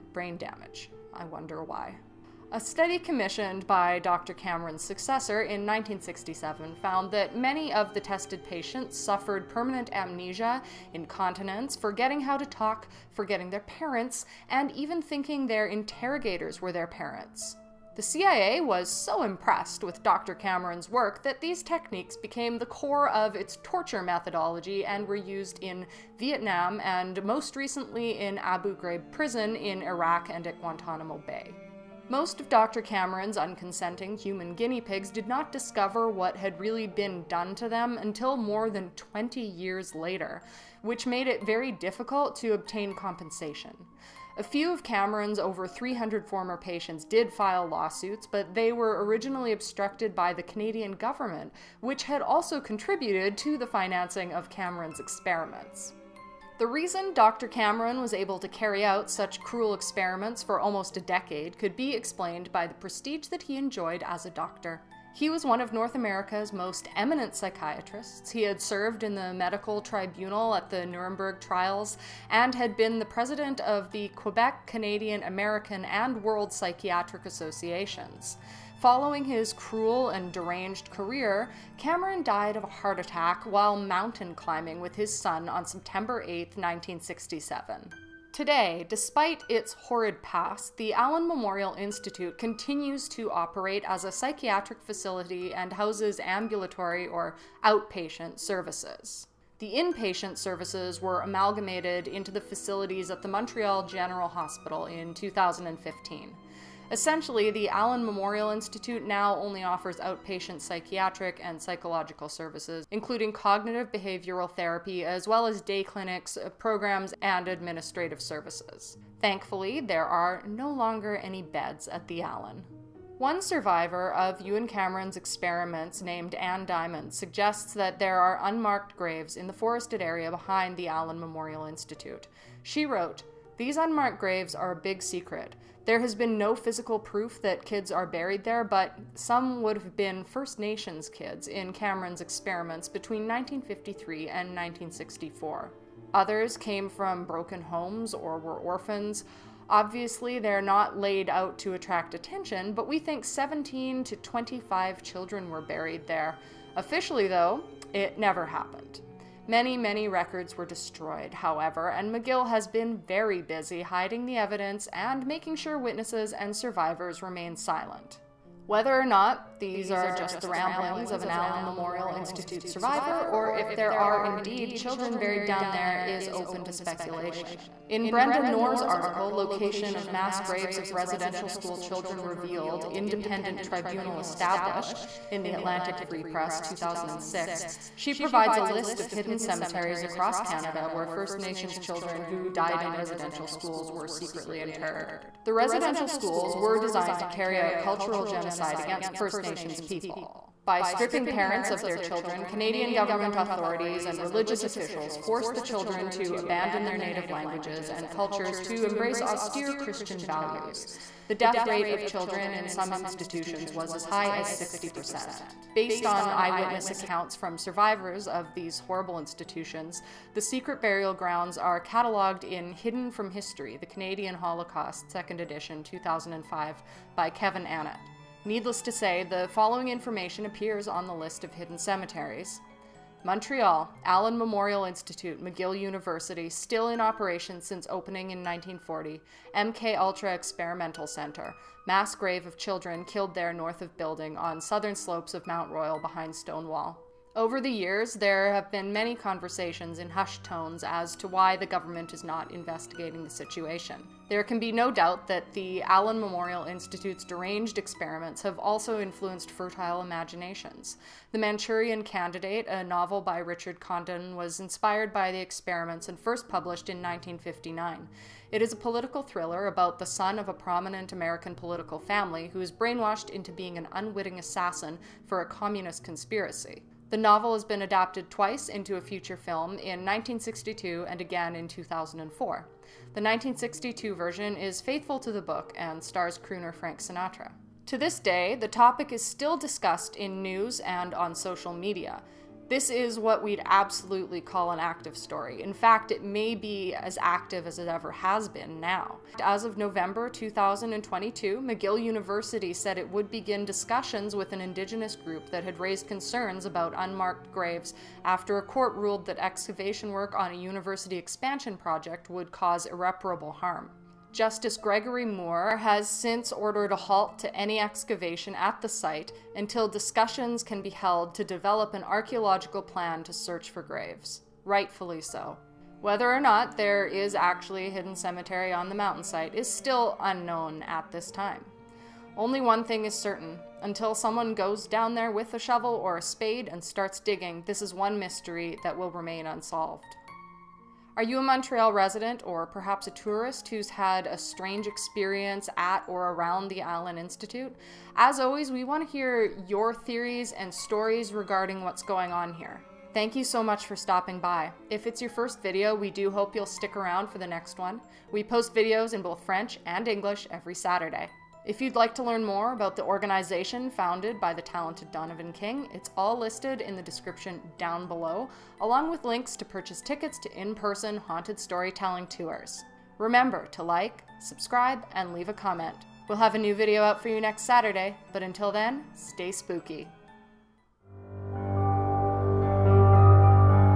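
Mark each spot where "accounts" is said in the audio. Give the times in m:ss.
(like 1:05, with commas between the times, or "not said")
3:36.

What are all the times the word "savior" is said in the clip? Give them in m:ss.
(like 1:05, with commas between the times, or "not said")
not said.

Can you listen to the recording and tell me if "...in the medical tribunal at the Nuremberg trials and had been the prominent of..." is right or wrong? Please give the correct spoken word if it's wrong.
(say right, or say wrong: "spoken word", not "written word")
wrong: "president", not "prominent".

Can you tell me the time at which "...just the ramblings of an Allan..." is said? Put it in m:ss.
2:50.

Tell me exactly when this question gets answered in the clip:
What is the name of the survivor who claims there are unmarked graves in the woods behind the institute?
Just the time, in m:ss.
2:06.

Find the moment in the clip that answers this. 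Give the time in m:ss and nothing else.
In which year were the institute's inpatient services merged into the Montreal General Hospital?
1:45.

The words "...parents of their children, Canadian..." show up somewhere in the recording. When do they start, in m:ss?
3:21.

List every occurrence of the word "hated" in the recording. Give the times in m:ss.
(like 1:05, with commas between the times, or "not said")
not said.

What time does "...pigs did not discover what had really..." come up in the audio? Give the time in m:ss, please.
0:34.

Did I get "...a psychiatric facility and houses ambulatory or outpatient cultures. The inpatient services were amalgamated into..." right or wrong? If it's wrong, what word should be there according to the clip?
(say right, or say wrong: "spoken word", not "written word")
wrong: "services", not "cultures".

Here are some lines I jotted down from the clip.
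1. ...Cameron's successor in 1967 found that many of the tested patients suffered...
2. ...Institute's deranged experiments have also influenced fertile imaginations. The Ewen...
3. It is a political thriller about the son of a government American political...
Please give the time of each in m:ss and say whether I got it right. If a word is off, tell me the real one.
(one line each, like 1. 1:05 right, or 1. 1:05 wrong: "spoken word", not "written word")
1. 0:04 right
2. 4:16 wrong: "Manchurian", not "Ewen"
3. 4:28 wrong: "prominent", not "government".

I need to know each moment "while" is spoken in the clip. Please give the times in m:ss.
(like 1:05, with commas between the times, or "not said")
1:23.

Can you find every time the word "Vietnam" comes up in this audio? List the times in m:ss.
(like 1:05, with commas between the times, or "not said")
0:26.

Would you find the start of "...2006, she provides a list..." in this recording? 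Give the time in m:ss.
3:06.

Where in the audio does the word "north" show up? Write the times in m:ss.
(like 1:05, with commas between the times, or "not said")
1:05, 4:03.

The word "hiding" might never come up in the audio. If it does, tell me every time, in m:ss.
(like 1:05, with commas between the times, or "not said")
2:43.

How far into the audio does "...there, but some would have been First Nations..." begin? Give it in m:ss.
2:18.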